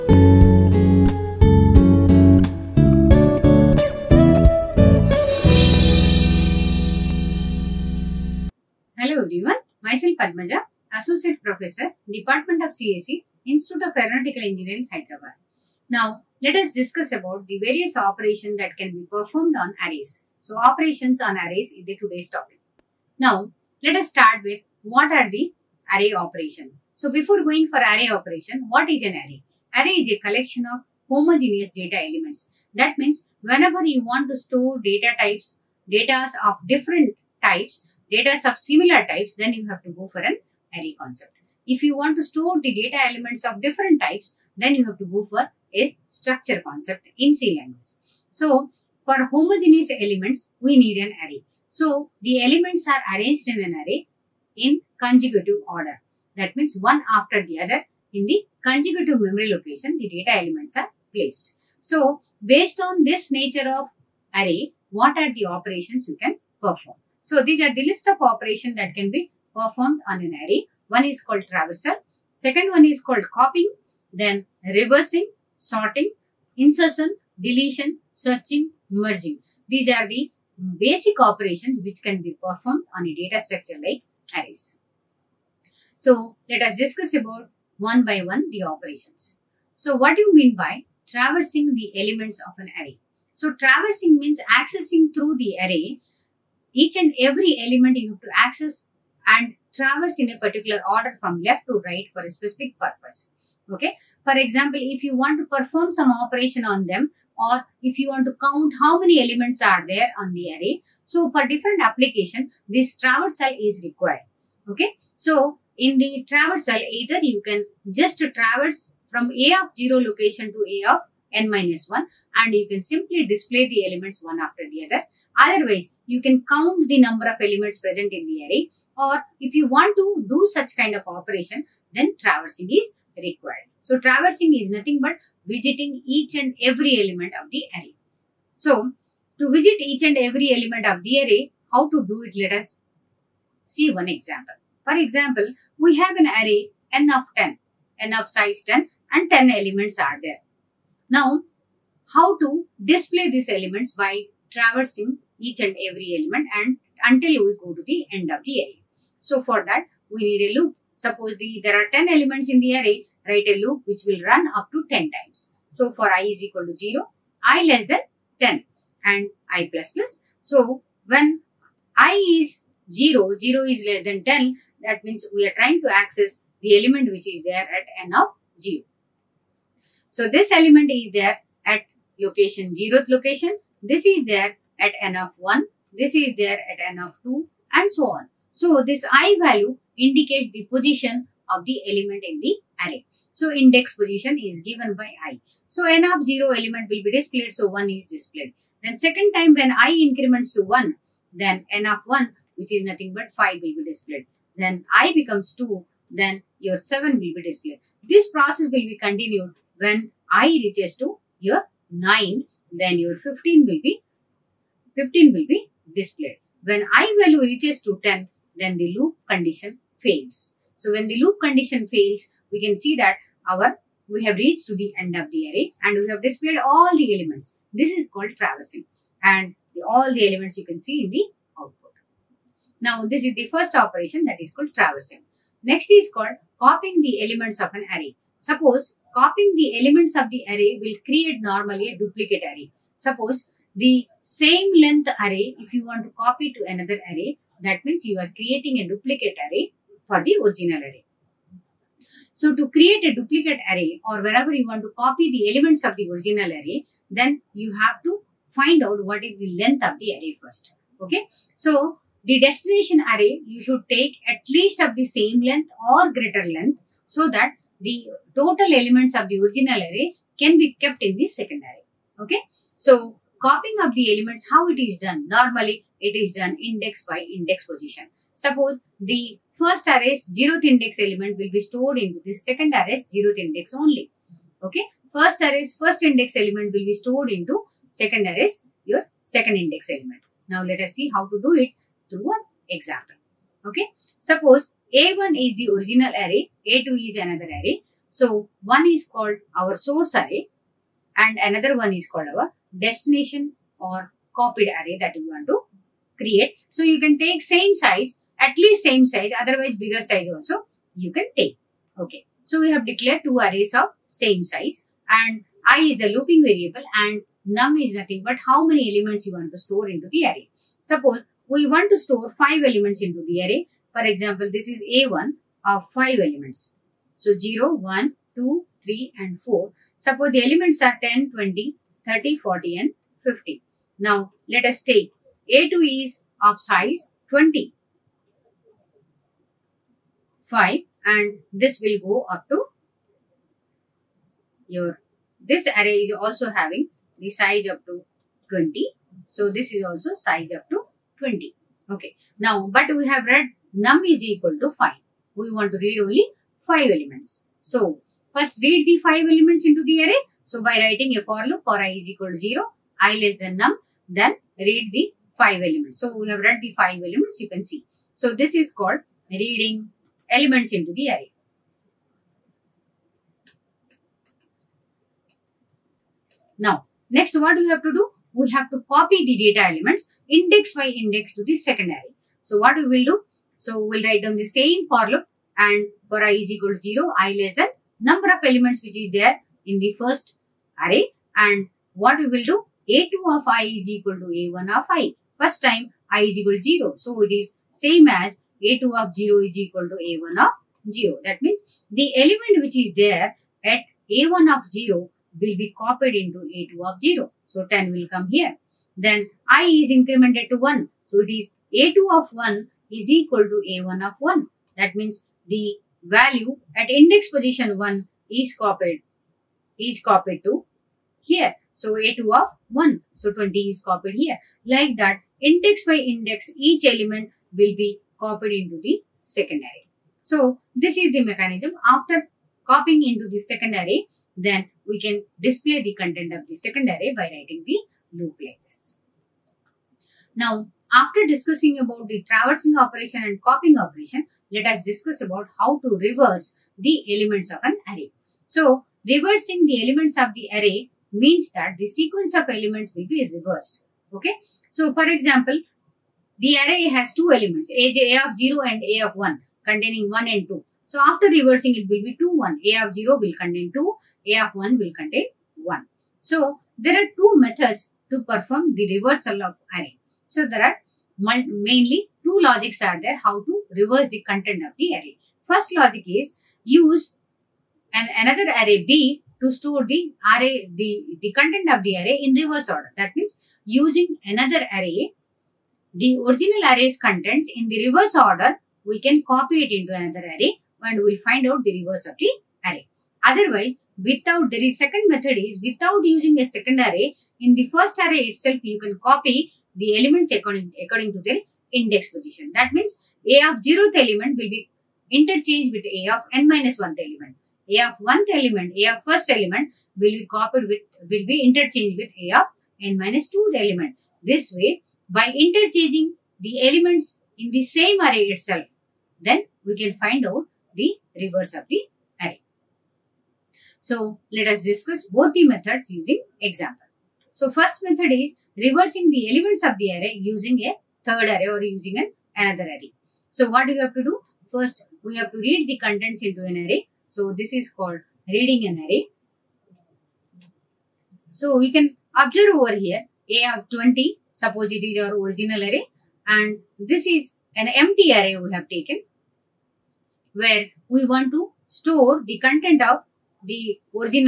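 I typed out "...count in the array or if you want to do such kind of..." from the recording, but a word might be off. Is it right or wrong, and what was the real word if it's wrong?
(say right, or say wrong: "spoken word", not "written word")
wrong: "present", not "count".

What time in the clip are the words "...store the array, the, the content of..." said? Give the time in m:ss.
7:59.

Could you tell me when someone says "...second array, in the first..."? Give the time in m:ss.
8:16.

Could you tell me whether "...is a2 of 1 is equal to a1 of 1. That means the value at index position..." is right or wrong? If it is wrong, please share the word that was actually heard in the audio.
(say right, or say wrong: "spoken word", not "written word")
right.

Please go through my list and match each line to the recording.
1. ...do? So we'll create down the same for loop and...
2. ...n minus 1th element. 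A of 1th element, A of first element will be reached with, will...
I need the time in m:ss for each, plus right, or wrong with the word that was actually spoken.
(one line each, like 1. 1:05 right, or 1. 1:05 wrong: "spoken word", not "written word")
1. 6:23 wrong: "write", not "create"
2. 8:26 wrong: "copied", not "reached".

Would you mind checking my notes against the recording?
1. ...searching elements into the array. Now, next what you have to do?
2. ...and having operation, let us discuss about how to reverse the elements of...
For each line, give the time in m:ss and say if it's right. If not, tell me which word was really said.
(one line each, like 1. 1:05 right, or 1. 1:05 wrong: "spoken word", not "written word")
1. 6:09 wrong: "reading", not "searching"
2. 7:23 wrong: "copying", not "having".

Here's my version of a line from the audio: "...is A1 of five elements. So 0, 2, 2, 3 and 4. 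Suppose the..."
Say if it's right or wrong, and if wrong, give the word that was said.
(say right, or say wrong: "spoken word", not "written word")
wrong: "1", not "2".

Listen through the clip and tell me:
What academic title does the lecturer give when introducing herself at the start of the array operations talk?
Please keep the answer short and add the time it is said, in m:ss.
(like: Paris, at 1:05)
Associate Professor, at 0:10.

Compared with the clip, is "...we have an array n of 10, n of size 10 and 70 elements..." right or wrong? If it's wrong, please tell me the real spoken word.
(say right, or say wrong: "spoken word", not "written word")
wrong: "10", not "70".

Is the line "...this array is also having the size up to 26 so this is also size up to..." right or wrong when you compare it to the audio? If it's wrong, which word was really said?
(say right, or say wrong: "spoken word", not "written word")
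wrong: "20", not "26".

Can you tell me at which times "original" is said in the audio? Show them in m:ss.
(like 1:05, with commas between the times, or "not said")
4:10, 4:16, 4:29, 4:55, 8:06, 9:05.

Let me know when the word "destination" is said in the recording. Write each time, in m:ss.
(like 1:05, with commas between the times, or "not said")
4:22, 5:02.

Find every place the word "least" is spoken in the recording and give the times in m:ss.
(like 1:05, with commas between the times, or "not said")
4:24, 5:08.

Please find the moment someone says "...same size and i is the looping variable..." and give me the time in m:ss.
5:14.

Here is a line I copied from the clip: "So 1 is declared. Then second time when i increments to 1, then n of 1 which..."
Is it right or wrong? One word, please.
wrong.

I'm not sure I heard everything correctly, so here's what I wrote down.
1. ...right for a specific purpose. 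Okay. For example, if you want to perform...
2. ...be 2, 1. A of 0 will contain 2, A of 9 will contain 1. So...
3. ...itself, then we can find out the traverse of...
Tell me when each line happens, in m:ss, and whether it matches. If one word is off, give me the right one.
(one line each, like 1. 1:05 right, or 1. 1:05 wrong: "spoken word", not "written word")
1. 1:41 right
2. 7:42 wrong: "1", not "9"
3. 8:38 wrong: "reverse", not "traverse".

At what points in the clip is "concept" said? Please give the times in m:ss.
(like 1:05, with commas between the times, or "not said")
0:40, 0:46.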